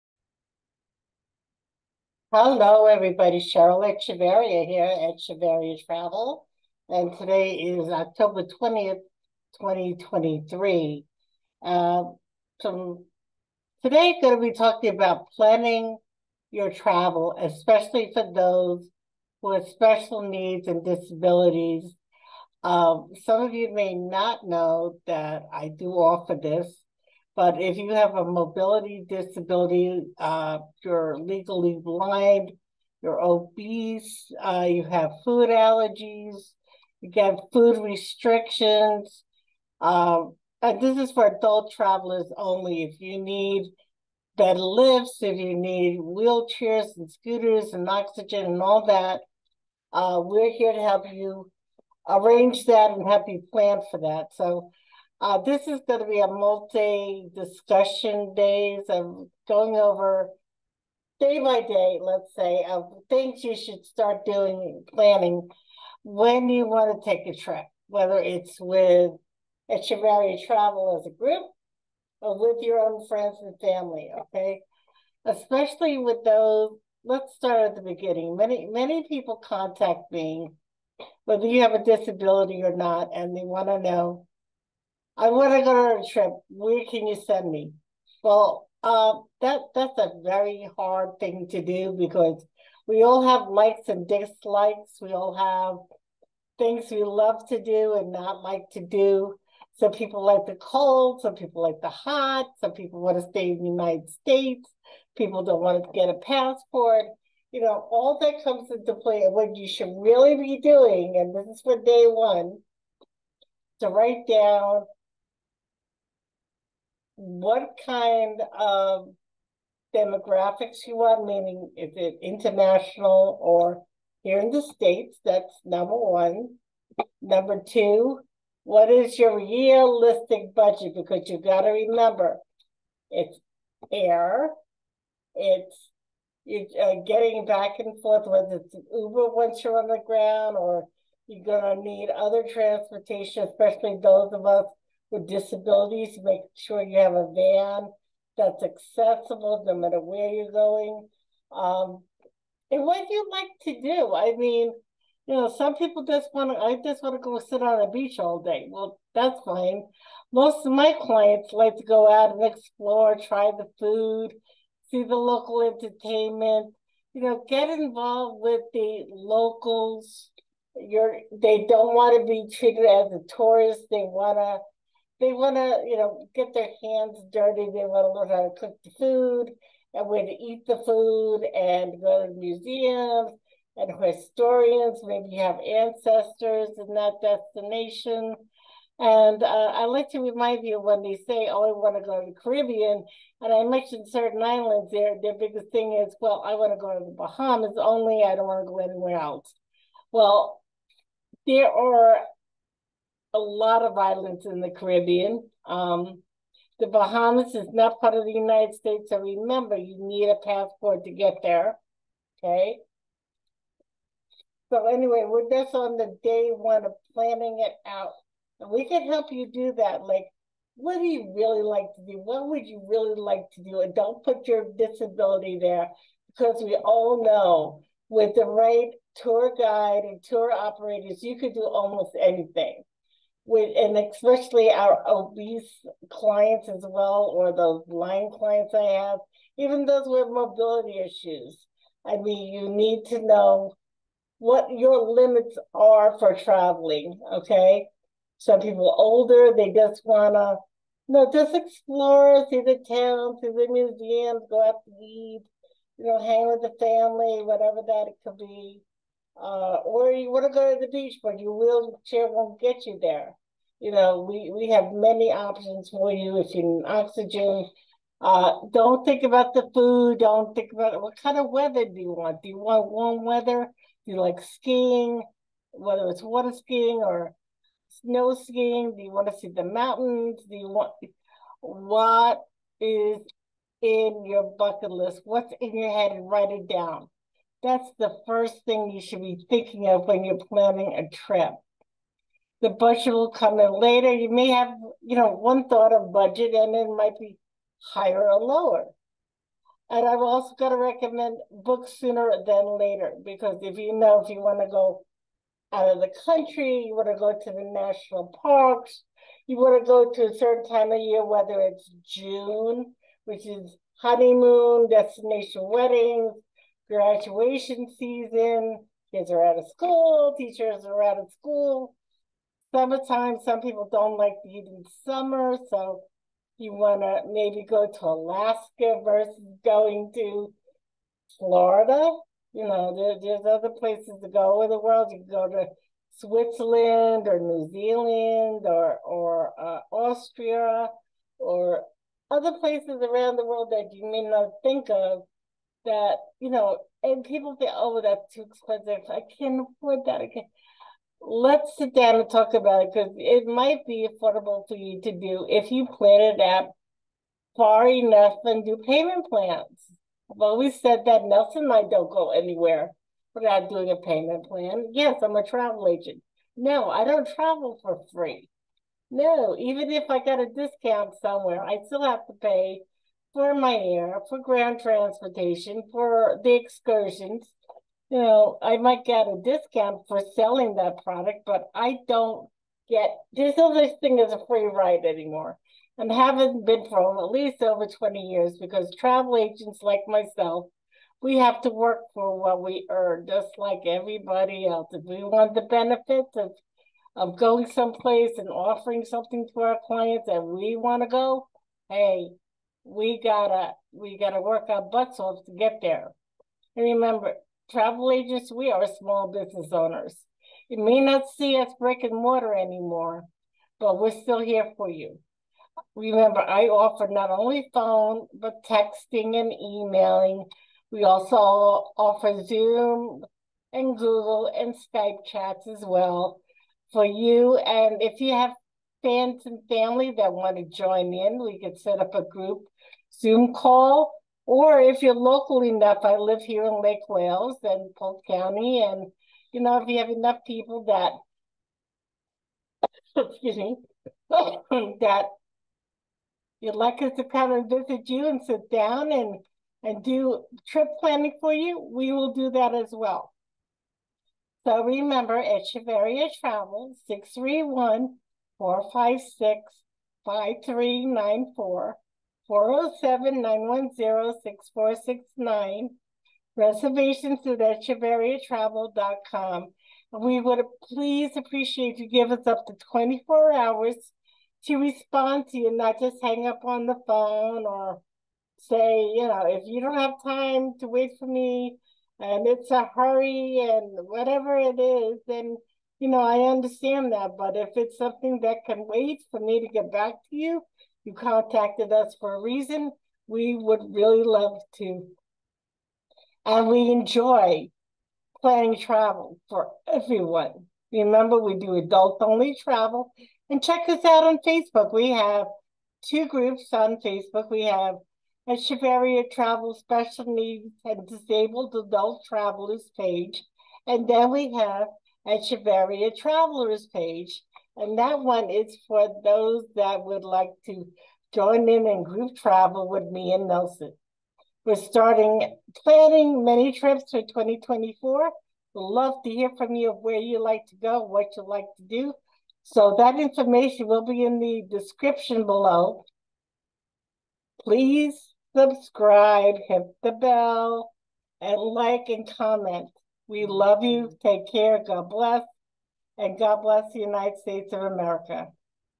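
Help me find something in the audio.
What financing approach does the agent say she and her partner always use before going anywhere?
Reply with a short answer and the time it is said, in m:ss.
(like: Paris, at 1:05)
Payment plan, at 6:03.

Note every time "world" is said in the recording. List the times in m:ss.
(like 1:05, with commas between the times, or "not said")
5:34, 5:43.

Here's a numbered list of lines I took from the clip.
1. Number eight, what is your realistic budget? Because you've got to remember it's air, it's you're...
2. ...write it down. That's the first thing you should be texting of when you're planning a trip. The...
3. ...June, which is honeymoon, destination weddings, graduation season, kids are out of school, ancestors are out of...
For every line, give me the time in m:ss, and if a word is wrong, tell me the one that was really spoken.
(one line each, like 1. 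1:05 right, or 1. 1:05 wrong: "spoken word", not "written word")
1. 2:07 wrong: "two", not "eight"
2. 4:46 wrong: "thinking", not "texting"
3. 5:12 wrong: "teachers", not "ancestors".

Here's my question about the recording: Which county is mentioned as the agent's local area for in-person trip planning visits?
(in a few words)
Polk County.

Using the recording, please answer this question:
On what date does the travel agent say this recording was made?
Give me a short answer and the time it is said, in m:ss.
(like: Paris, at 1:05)
October 20th, 2023, at 0:07.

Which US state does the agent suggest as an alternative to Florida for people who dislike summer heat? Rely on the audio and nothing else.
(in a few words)
Alaska.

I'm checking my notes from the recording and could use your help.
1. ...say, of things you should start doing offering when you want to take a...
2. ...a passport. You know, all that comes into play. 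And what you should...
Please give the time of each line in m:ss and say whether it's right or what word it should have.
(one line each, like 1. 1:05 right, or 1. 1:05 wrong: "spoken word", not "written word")
1. 1:02 wrong: "planning", not "offering"
2. 1:46 right.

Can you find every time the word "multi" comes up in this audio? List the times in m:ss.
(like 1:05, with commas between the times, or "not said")
0:56.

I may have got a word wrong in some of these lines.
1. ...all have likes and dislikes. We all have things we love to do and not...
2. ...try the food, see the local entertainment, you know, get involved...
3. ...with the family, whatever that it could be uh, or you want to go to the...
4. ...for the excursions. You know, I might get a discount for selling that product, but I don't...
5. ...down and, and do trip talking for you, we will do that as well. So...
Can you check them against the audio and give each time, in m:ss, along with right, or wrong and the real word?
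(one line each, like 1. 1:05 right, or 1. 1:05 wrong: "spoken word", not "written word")
1. 1:33 right
2. 2:43 right
3. 4:16 right
4. 6:15 right
5. 7:28 wrong: "planning", not "talking".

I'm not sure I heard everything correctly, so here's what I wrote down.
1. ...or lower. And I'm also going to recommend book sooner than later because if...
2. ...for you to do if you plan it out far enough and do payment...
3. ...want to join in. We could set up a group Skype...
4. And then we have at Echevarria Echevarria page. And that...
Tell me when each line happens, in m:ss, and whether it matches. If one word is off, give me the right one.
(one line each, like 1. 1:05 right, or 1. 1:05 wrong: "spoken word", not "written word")
1. 4:58 right
2. 5:54 right
3. 7:10 wrong: "Zoom", not "Skype"
4. 8:33 wrong: "Travelers", not "Echevarria".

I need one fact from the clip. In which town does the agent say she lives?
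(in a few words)
Lake Wales.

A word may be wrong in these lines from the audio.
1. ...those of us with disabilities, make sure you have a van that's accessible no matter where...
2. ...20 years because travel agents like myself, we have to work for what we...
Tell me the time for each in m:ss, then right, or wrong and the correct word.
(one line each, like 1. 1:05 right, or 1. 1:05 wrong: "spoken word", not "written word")
1. 2:24 right
2. 6:27 right.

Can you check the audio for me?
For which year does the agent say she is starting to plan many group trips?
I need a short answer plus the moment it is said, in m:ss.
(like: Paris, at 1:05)
2024, at 8:47.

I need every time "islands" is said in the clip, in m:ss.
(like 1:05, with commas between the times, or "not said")
3:14, 3:23.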